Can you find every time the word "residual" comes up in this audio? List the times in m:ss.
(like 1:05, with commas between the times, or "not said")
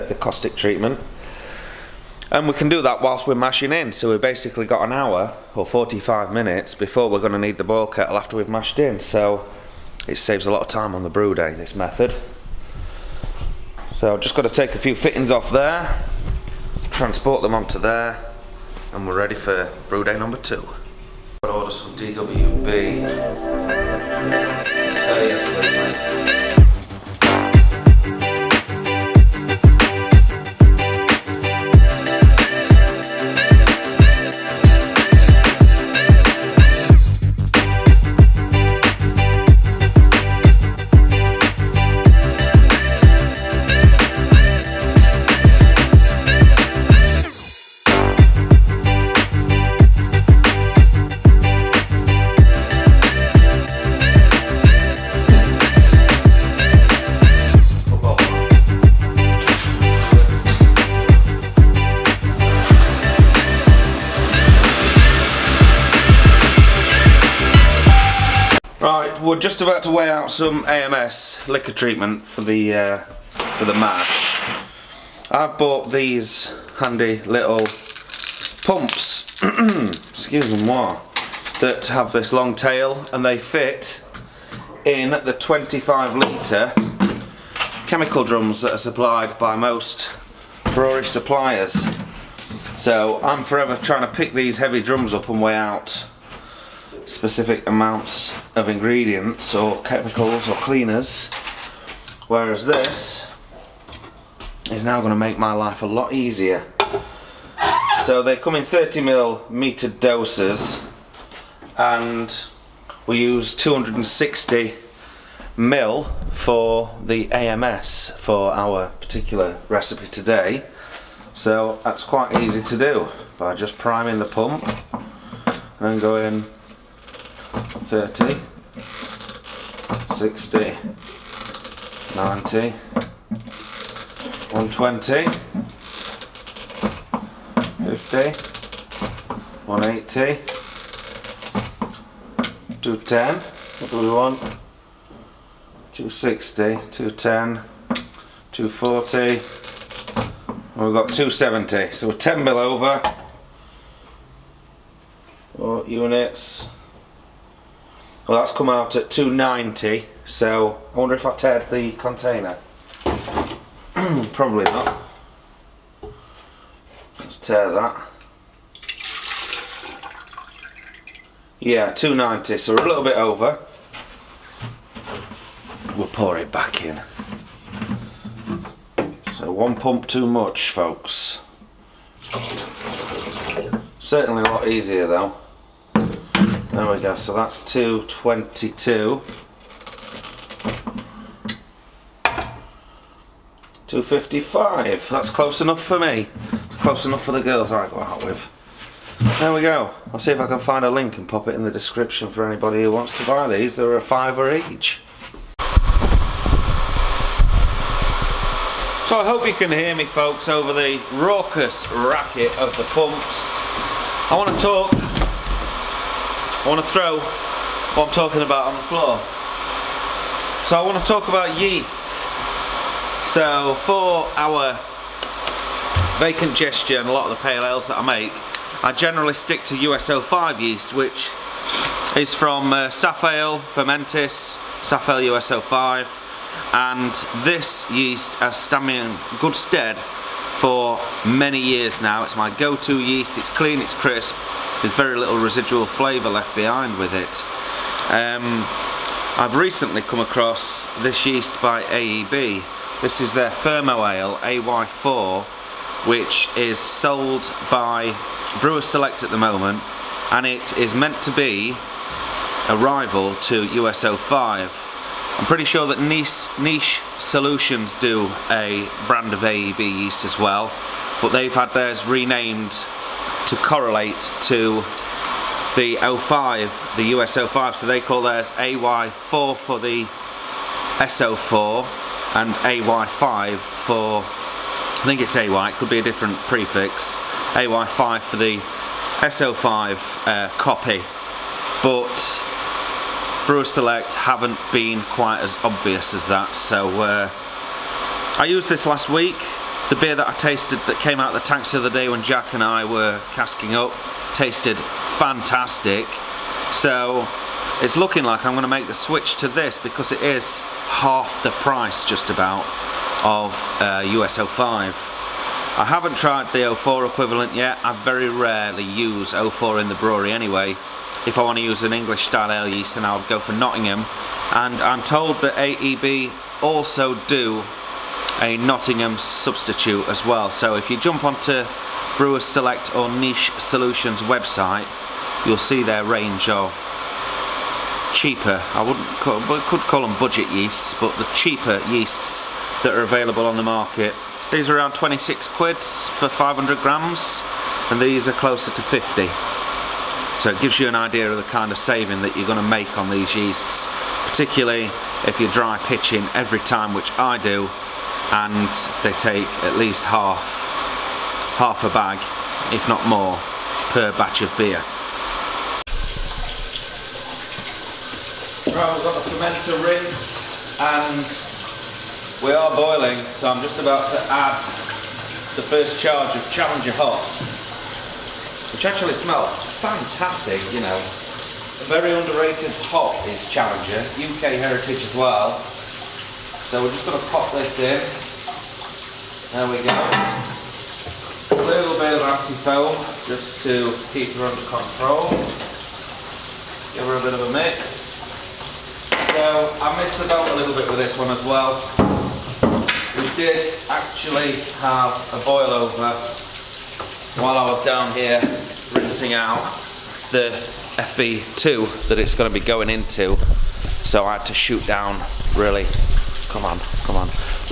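4:05.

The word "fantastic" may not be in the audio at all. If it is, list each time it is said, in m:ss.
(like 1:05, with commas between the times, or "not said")
5:05, 6:19.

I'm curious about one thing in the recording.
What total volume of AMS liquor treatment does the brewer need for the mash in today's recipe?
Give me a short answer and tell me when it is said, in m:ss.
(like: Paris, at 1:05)
260 ml, at 1:53.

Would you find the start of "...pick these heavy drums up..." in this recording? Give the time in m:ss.
1:34.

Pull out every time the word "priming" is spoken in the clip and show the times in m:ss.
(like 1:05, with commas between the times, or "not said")
2:03.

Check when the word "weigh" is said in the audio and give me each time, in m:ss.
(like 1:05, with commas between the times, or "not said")
1:09, 1:35.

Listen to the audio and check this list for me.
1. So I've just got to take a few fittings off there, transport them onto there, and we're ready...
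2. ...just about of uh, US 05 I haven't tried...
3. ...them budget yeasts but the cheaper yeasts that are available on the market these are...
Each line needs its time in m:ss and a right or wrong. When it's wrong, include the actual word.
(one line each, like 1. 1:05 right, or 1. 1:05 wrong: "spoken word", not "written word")
1. 0:13 right
2. 5:12 right
3. 5:40 right.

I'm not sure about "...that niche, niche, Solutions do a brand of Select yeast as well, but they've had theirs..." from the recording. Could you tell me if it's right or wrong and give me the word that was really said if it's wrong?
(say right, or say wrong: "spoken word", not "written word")
wrong: "AEB", not "Select".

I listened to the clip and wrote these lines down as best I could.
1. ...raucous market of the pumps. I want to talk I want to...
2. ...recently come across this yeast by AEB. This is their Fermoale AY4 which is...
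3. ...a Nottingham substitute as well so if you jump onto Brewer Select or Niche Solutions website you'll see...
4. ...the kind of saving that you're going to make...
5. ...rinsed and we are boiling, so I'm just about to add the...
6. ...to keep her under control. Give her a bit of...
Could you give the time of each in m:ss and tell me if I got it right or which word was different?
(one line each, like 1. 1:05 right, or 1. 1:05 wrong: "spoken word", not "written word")
1. 3:31 wrong: "racket", not "market"
2. 4:09 right
3. 5:28 right
4. 5:51 right
5. 6:09 right
6. 6:33 right.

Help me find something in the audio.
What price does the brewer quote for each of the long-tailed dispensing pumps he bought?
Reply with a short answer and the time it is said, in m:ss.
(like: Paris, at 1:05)
a fiver, at 3:23.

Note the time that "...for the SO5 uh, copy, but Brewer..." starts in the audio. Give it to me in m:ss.
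4:48.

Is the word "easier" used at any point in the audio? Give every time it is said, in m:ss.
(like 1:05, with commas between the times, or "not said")
1:46, 3:04.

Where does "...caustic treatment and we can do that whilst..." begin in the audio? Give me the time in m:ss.
0:00.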